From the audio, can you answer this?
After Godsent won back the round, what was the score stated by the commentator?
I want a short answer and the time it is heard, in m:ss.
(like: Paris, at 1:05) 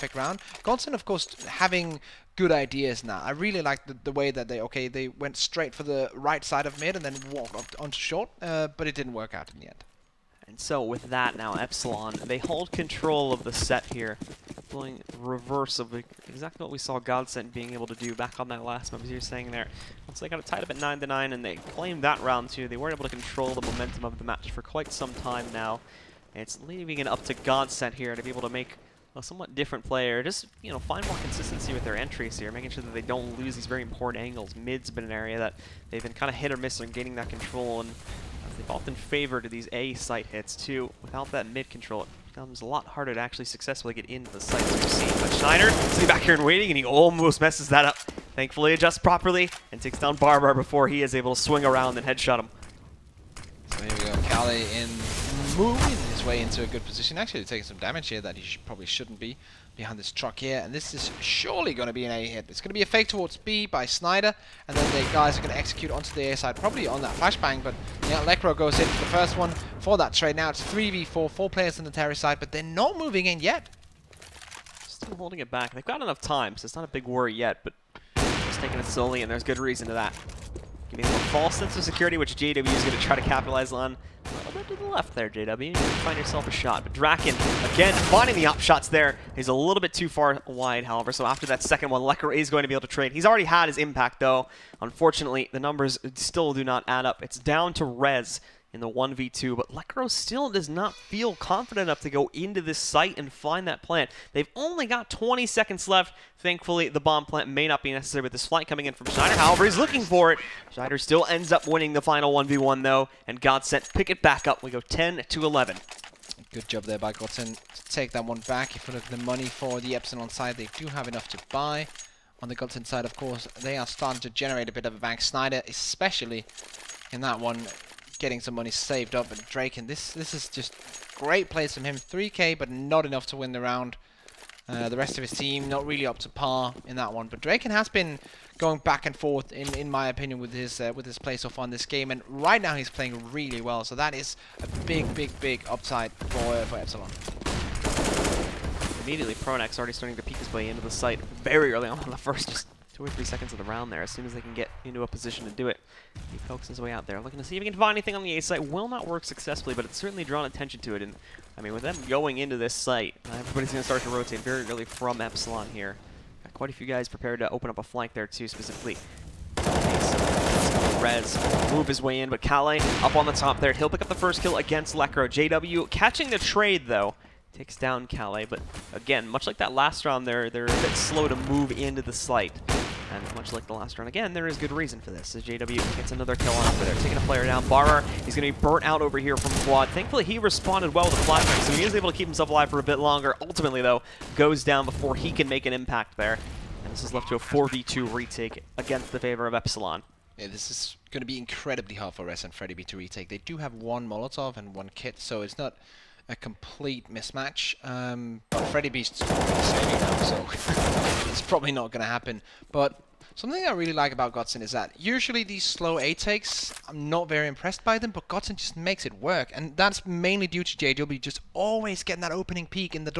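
10-11, at 1:54.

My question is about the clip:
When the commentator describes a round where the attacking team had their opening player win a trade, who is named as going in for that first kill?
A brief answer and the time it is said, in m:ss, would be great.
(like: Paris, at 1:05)
Lekr0, at 1:08.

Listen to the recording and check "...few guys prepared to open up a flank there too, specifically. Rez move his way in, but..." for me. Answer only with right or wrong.
right.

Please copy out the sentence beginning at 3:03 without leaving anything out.
And much like the last run, again, there is good reason for this.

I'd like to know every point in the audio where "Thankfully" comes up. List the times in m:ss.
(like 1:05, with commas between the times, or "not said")
0:48, 1:46, 3:09.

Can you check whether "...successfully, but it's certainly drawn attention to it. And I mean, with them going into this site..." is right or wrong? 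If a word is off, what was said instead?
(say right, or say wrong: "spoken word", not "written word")
right.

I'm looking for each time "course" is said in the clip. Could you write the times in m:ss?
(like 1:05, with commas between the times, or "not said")
0:01, 2:03.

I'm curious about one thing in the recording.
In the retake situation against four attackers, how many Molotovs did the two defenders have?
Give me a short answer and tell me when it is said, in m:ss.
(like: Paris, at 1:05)
1, at 3:23.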